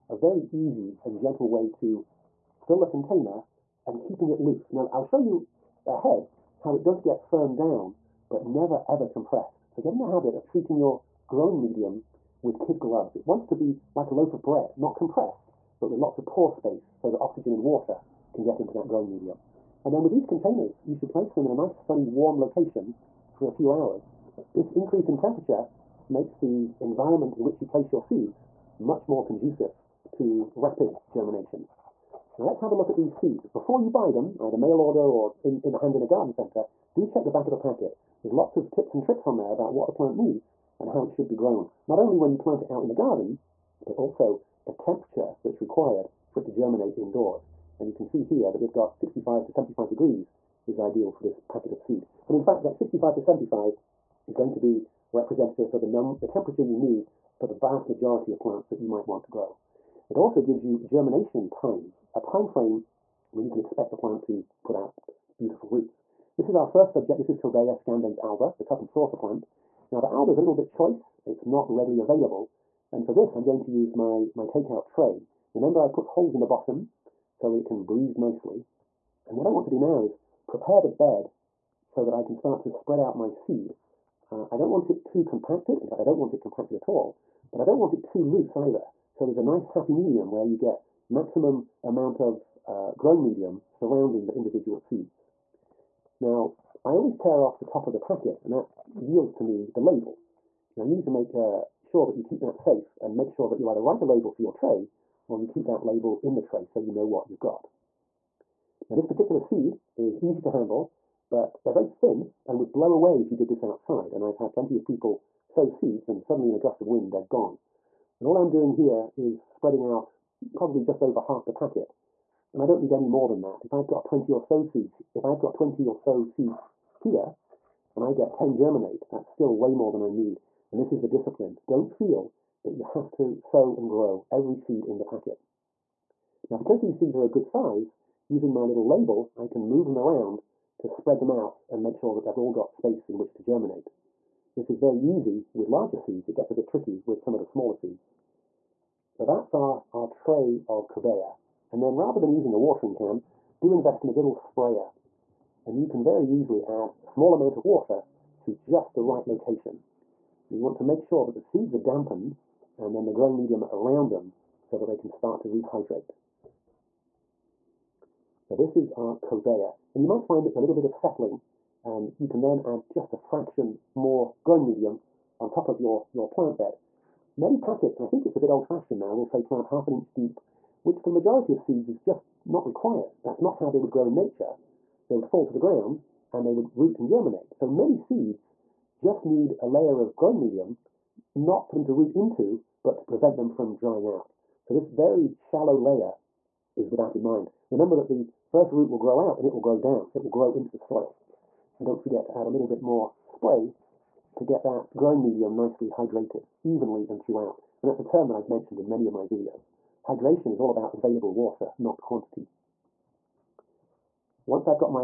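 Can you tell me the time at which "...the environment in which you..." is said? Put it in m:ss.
0:26.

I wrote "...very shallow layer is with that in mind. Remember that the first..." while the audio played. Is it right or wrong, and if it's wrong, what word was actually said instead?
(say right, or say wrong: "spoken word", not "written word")
right.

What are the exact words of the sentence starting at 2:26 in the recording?
It gets a bit tricky with some of the smaller seeds.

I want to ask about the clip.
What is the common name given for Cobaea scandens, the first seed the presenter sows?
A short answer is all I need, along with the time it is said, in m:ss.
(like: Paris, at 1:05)
cup and saucer plant, at 1:08.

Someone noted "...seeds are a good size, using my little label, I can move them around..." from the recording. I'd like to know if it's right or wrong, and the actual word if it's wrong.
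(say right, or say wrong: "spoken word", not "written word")
right.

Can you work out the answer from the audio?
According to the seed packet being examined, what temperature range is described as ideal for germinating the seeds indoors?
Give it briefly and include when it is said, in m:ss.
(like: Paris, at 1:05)
65 to 75 degrees, at 0:48.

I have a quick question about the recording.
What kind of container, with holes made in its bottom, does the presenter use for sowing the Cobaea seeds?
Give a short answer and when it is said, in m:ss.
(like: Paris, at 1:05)
takeout tray, at 1:14.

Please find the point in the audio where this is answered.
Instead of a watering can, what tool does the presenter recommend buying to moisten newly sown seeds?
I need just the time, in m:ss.
2:34.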